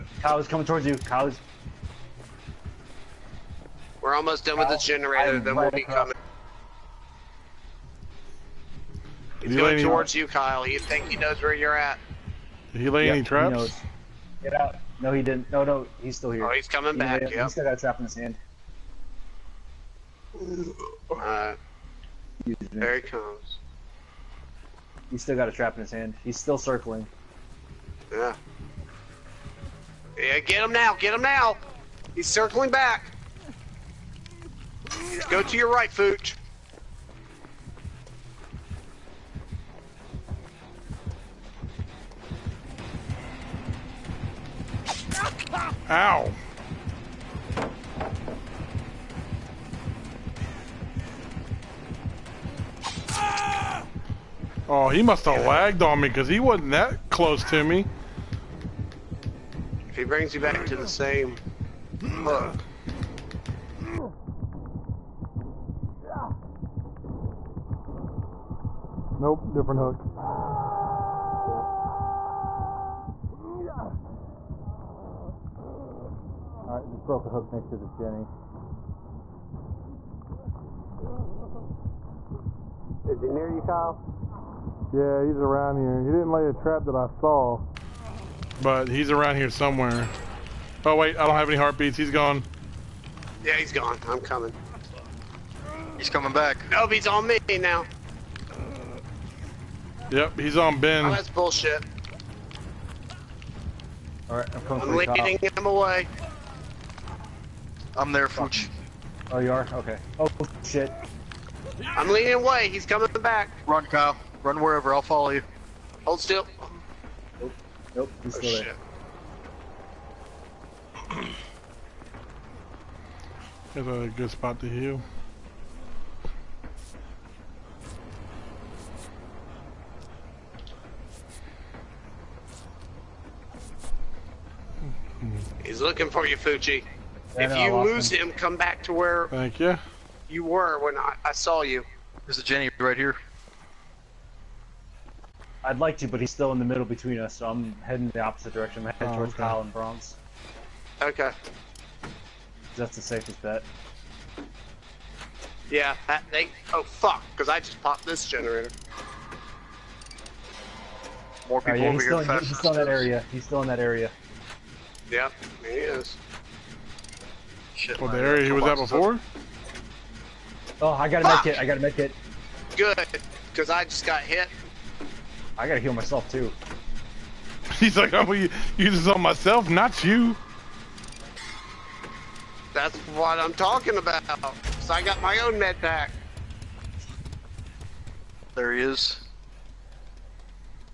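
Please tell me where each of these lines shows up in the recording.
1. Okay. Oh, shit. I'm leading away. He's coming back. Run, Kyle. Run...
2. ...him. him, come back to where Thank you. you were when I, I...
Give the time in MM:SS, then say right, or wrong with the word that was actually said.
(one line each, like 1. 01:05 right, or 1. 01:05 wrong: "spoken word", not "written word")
1. 01:49 right
2. 02:18 right.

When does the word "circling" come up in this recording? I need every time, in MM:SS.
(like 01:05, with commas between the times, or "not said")
00:26, 00:32.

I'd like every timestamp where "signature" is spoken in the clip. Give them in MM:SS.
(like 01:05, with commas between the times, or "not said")
not said.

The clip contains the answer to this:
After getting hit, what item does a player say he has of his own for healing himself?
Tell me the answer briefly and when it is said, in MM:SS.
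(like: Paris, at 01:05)
med pack, at 03:05.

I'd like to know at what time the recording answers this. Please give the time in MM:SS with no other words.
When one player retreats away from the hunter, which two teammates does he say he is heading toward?
02:29.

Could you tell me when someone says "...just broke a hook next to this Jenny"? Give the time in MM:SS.
01:16.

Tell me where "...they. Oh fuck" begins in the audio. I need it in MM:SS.
02:36.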